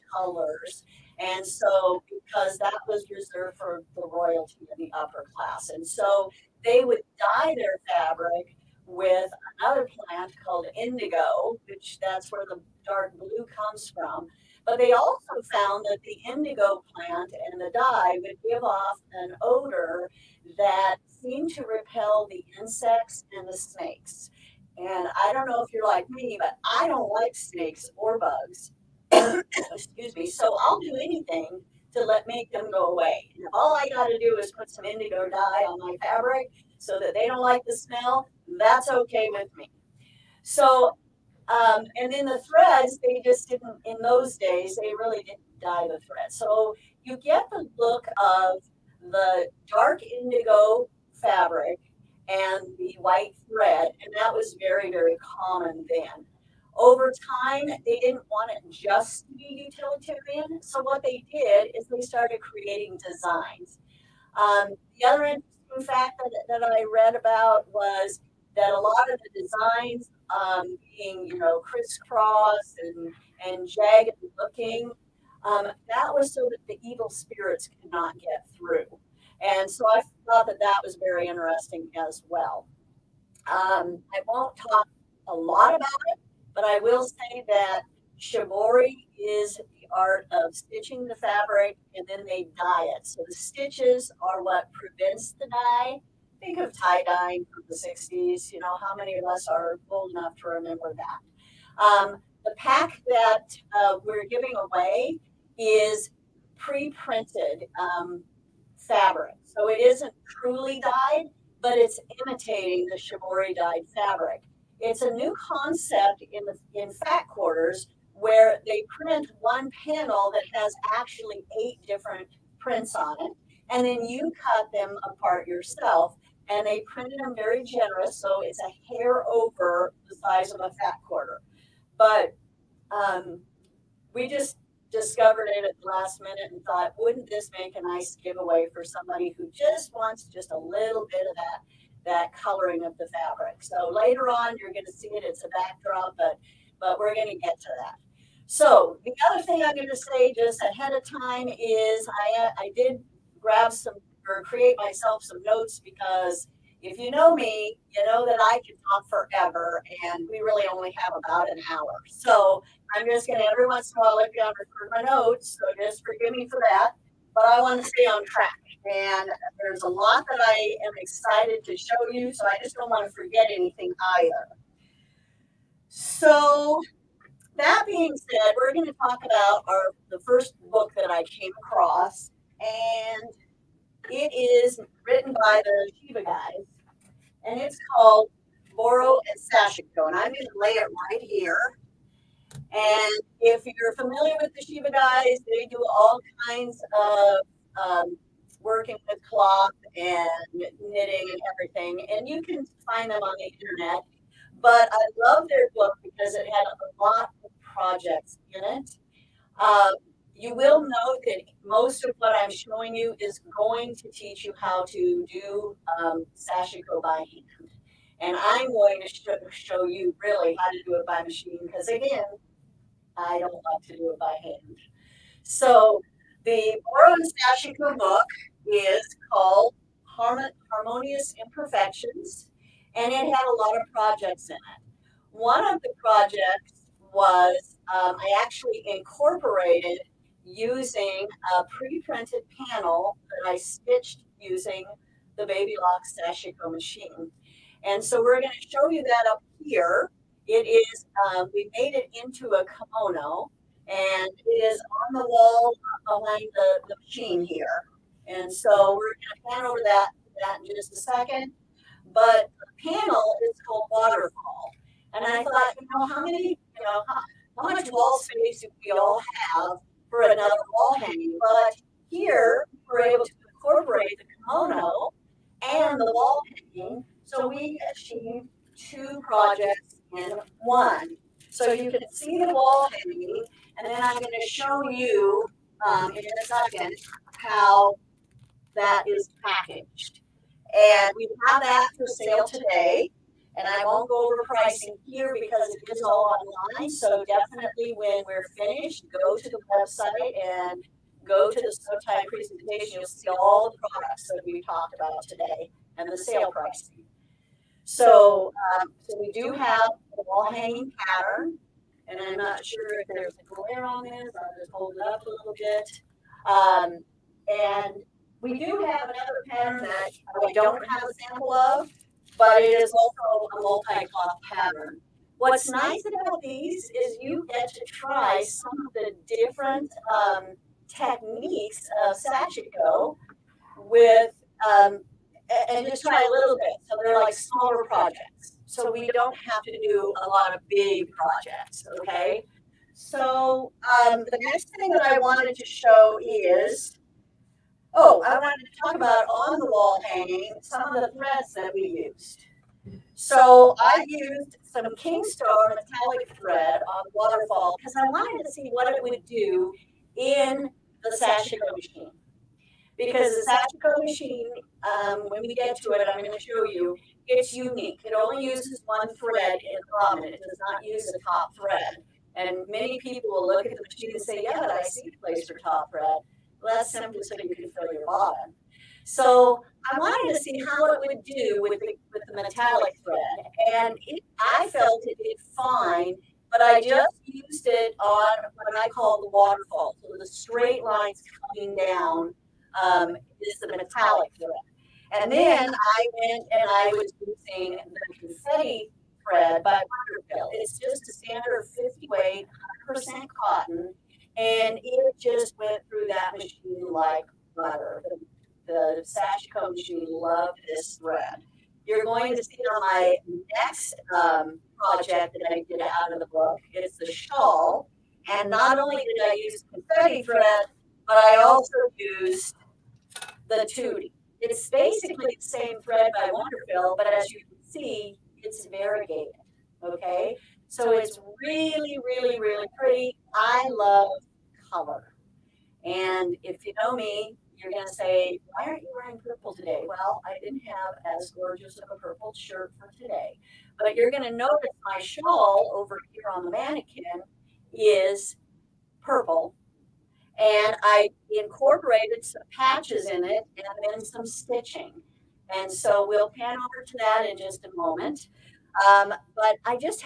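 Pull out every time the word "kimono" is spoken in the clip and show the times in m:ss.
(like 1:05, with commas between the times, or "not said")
4:12, 4:34.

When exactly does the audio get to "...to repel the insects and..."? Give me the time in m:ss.
0:21.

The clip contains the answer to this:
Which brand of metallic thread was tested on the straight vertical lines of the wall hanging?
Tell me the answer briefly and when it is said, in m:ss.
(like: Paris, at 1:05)
Kingstar, at 5:54.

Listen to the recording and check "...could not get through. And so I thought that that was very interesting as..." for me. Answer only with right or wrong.
right.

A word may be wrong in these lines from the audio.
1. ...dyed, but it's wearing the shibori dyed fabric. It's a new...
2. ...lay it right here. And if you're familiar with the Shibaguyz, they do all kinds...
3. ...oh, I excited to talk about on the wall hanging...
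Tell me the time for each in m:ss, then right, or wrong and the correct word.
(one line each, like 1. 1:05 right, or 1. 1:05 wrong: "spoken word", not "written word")
1. 1:50 wrong: "imitating", not "wearing"
2. 3:10 right
3. 5:48 wrong: "wanted", not "excited".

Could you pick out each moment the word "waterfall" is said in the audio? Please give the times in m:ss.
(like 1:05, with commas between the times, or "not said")
4:23, 5:57, 6:29.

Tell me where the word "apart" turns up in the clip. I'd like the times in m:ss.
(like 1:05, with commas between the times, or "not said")
2:05.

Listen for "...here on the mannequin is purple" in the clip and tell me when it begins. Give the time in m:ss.
7:26.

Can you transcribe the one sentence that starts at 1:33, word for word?
So the stitches are what prevents the dye.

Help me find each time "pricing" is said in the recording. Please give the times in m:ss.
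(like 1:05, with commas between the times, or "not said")
4:54, 5:06.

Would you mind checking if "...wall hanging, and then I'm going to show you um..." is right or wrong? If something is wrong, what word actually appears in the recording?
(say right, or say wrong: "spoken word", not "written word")
right.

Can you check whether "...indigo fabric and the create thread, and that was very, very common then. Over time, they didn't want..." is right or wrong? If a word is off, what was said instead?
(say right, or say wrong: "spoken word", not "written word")
wrong: "white", not "create".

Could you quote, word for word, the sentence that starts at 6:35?
And then I went and I was using the confetti thread by WonderFil.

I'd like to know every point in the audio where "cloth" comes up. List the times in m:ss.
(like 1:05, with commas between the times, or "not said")
3:19, 5:23.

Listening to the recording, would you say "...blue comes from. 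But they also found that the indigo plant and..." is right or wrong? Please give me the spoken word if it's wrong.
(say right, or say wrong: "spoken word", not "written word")
right.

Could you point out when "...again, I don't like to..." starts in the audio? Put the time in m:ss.
3:41.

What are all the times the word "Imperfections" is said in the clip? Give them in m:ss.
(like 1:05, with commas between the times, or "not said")
3:51.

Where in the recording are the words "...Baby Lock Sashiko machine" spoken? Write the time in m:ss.
4:05.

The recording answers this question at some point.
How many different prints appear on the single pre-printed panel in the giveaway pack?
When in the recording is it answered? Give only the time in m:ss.
2:01.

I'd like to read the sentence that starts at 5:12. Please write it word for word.
And I'm not sure if there's a glare on this.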